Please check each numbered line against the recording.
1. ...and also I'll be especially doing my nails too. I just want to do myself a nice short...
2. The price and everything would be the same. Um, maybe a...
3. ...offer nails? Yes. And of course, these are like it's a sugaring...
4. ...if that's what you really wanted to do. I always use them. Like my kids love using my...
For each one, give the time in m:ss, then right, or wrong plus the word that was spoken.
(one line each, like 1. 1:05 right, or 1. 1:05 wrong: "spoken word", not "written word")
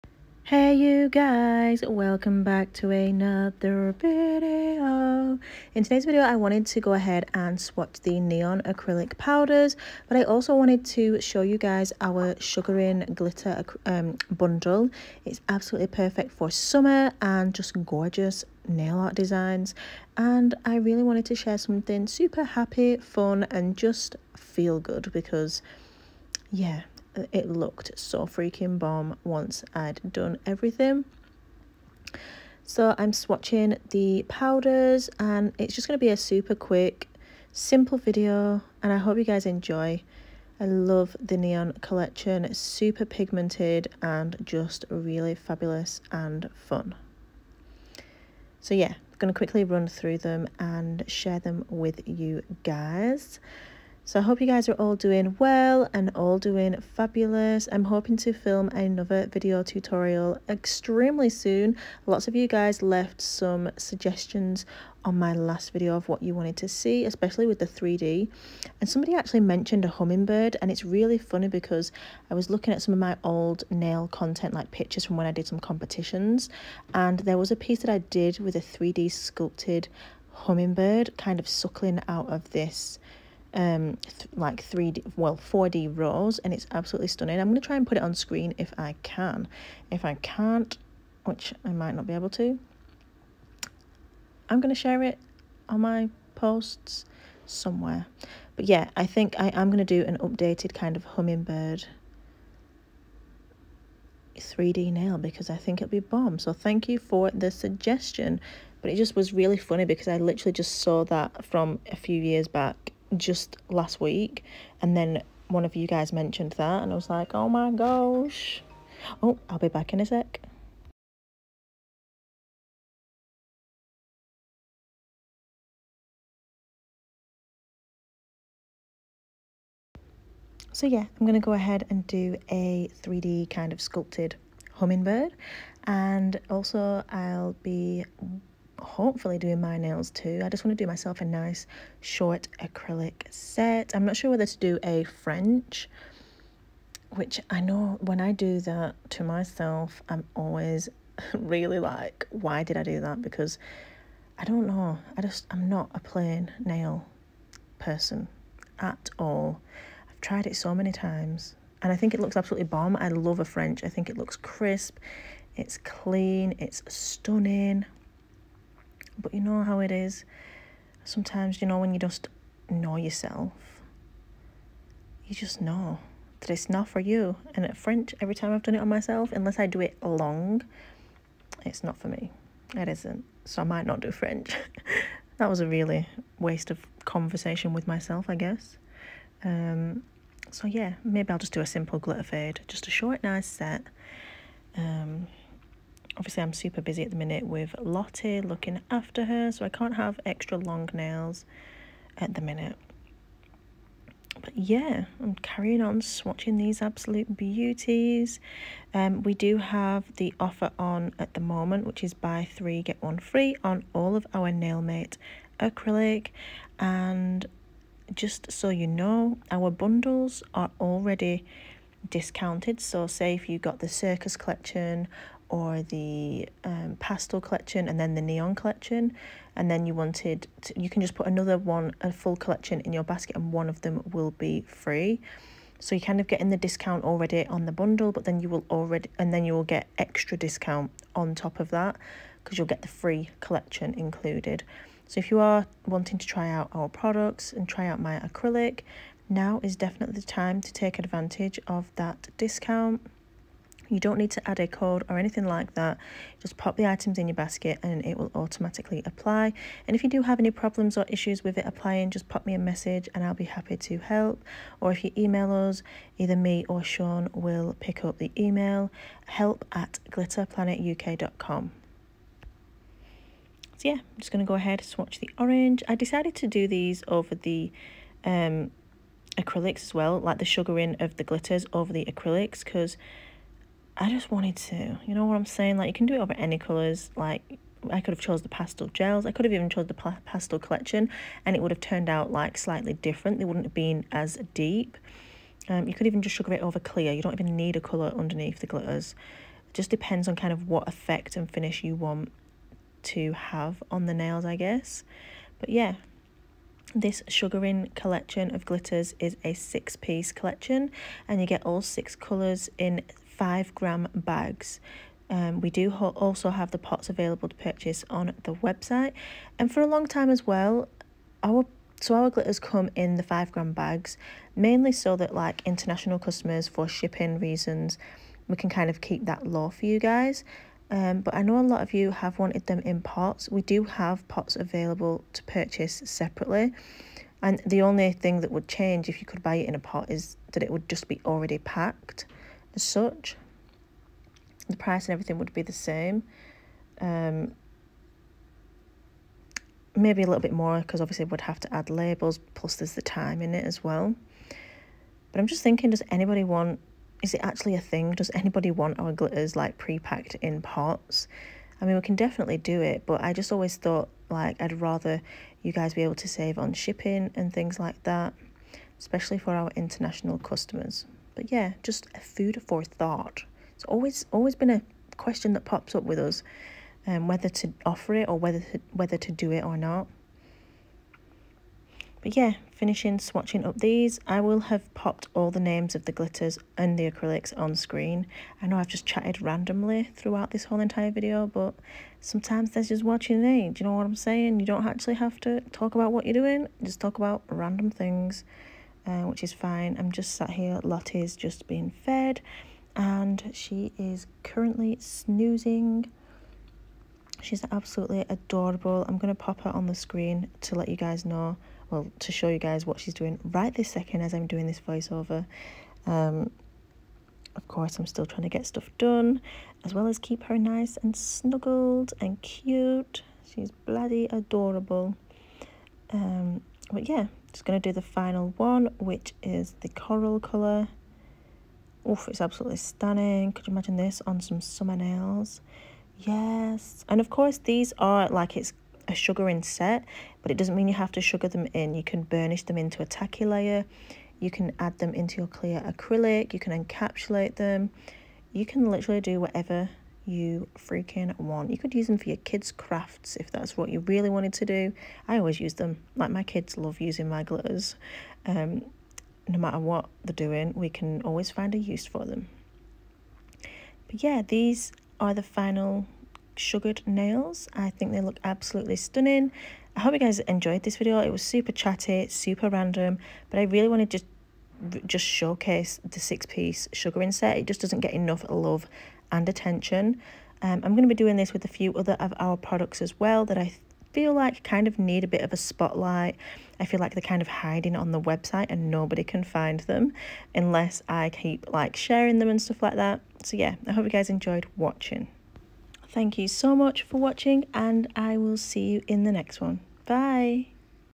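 1. 2:15 wrong: "hopefully", not "especially"
2. 5:44 right
3. 7:14 wrong: "summer", not "offer"
4. 7:33 right.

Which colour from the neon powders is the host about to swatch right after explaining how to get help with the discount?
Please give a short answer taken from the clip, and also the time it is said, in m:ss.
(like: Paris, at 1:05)
Orange, at 4:35.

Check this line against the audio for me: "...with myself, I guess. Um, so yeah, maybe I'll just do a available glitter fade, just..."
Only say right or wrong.
wrong.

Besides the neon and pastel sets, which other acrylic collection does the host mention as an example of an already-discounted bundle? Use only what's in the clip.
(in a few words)
Circus collection.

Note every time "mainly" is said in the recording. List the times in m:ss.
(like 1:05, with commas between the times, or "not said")
5:24.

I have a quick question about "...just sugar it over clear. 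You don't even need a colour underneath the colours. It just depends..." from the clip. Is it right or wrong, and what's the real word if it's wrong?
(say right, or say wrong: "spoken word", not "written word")
wrong: "glitters", not "colours".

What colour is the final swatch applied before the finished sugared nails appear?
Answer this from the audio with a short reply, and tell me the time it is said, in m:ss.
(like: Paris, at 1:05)
Coral, at 7:09.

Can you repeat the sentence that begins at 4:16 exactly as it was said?
Just pop the items in your basket and it will automatically apply.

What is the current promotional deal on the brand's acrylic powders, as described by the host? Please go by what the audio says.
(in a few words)
Buy three get one free.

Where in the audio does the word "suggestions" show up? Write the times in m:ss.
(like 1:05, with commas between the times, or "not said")
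1:03, 1:47.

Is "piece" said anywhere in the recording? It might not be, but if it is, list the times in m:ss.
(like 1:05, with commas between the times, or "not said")
1:17, 5:09, 7:56.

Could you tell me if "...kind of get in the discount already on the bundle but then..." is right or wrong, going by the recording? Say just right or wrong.
right.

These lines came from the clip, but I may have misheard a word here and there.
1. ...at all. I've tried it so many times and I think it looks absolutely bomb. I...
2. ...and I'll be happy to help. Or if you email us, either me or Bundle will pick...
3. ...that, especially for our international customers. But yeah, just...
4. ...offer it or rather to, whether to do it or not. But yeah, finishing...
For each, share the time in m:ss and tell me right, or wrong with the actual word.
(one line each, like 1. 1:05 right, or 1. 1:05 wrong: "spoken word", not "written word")
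1. 2:38 right
2. 4:23 wrong: "Sean", not "Bundle"
3. 6:08 right
4. 6:17 wrong: "whether", not "rather".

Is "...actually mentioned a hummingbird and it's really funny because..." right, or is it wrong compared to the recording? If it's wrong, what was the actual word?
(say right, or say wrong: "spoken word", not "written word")
right.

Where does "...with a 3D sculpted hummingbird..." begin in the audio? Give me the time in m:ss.
1:18.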